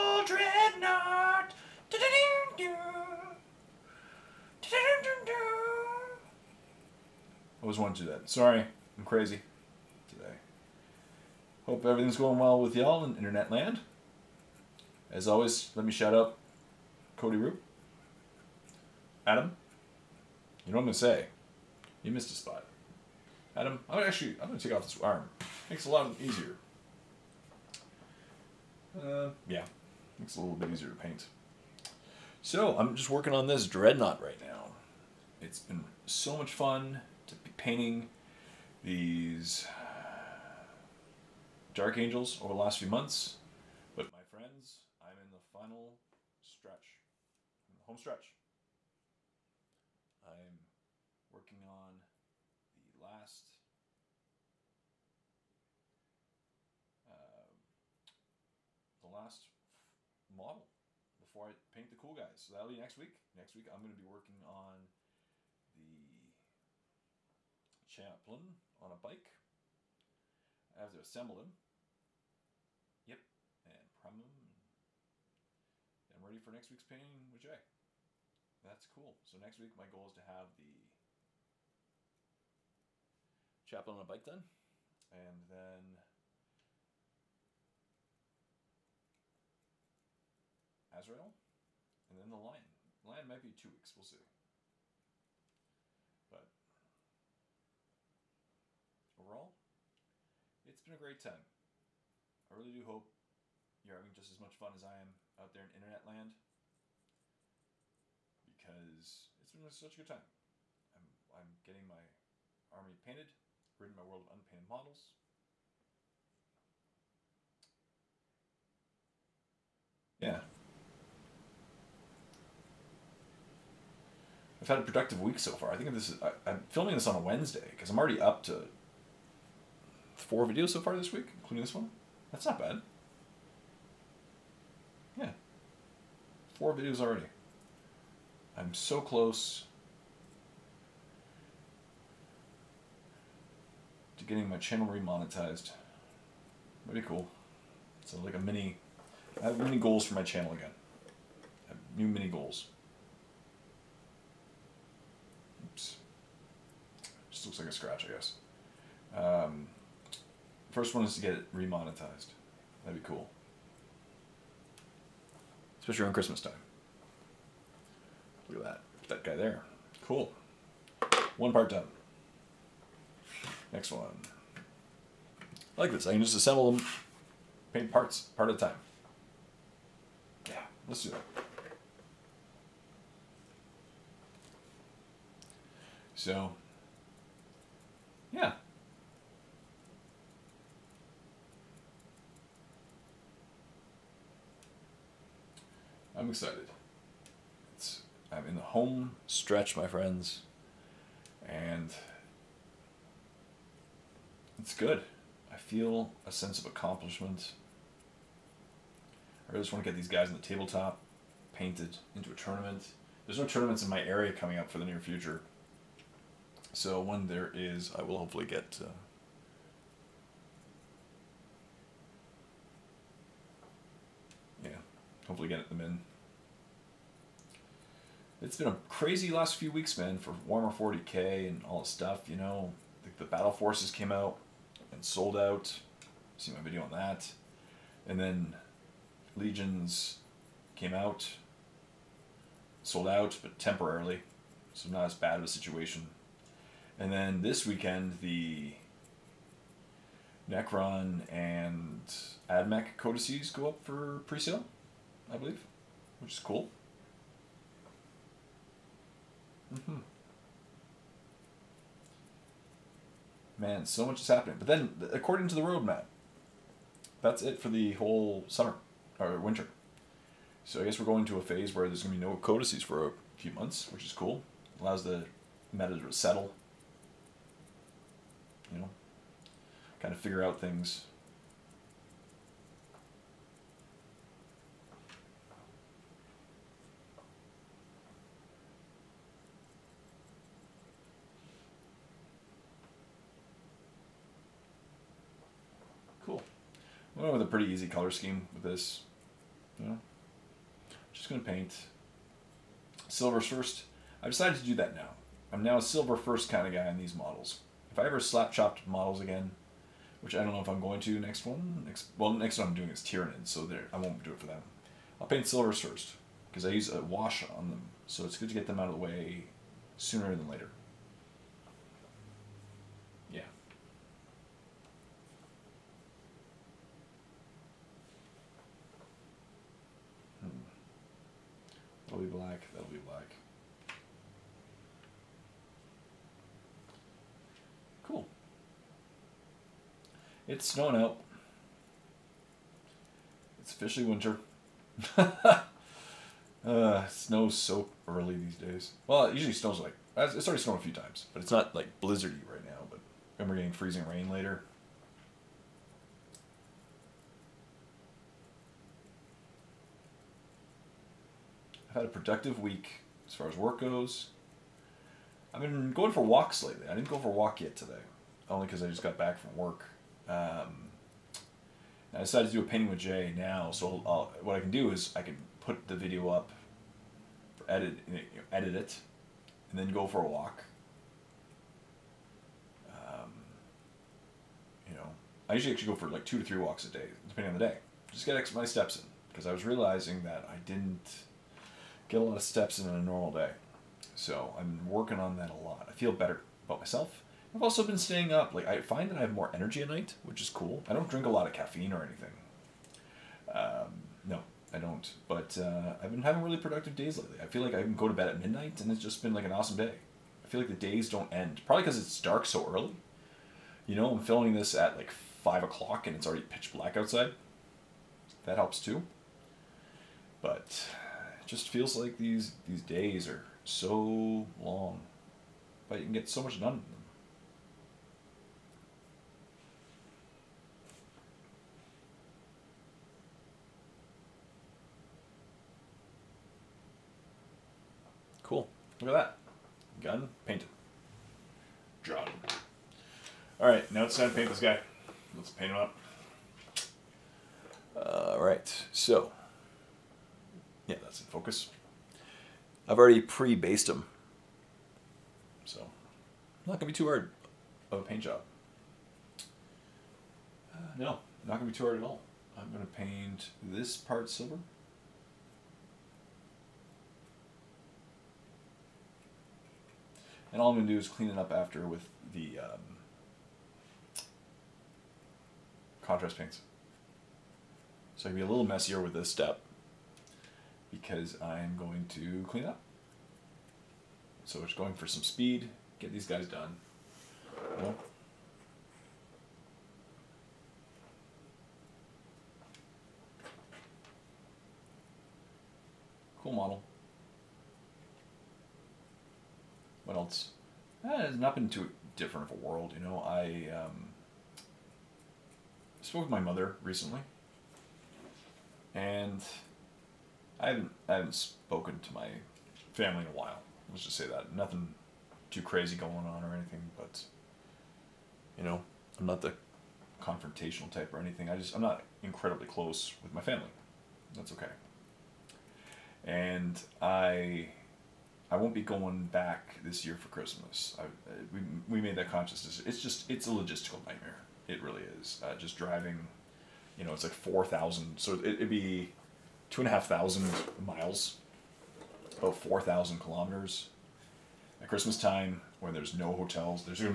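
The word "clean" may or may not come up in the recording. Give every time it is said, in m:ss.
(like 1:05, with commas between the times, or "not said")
7:51, 8:02.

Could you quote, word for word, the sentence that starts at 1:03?
Next week I'm going to be working on the chaplain on a bike.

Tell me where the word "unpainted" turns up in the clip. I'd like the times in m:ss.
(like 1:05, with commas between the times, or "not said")
1:54.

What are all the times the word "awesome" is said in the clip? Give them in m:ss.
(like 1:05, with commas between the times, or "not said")
6:49.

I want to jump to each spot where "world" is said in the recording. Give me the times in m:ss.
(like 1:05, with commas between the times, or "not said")
1:54, 8:22.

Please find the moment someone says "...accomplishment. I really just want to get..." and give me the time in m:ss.
3:26.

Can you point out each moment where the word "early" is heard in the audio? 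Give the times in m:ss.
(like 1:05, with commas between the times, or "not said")
5:48, 6:52.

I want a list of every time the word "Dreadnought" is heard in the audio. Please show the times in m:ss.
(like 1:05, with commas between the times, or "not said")
0:00, 0:33.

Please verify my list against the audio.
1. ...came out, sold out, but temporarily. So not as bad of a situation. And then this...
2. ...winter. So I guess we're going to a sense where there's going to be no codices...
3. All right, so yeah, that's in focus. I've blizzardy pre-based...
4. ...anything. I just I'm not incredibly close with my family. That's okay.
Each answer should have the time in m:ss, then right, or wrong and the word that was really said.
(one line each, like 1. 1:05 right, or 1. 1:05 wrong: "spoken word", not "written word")
1. 4:00 right
2. 4:29 wrong: "phase", not "sense"
3. 7:27 wrong: "already", not "blizzardy"
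4. 8:41 right.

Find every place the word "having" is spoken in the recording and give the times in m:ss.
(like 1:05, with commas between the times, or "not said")
1:43, 6:46.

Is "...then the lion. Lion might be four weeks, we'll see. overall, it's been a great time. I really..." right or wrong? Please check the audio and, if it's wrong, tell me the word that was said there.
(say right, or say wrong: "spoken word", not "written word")
wrong: "two", not "four".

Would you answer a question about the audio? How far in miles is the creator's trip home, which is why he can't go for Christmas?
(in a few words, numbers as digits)
2,500 miles.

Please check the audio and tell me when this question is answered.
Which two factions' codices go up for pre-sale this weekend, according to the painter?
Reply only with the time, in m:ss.
4:10.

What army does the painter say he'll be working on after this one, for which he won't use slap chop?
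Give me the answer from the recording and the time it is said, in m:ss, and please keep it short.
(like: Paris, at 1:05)
Tyranid, at 5:13.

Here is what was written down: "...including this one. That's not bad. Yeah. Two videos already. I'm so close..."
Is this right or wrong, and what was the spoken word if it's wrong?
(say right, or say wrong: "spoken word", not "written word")
wrong: "Four", not "Two".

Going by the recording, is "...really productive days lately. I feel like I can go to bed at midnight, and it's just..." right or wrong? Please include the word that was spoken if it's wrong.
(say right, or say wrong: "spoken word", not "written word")
right.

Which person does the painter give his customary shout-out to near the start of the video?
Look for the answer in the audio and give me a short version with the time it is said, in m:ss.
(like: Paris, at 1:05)
Cody Roop, at 0:17.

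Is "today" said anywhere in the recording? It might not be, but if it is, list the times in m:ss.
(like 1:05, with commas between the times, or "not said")
0:10, 6:07.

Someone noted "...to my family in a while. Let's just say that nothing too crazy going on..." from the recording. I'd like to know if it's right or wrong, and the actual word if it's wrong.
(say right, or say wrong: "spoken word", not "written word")
right.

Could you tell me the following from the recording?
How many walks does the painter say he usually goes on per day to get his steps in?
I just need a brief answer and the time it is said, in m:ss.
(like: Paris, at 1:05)
2 to 3, at 6:26.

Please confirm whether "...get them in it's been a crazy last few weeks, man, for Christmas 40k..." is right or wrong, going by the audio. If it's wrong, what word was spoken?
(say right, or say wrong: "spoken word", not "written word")
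wrong: "Warhammer", not "Christmas".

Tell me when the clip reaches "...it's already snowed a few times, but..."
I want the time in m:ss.
5:50.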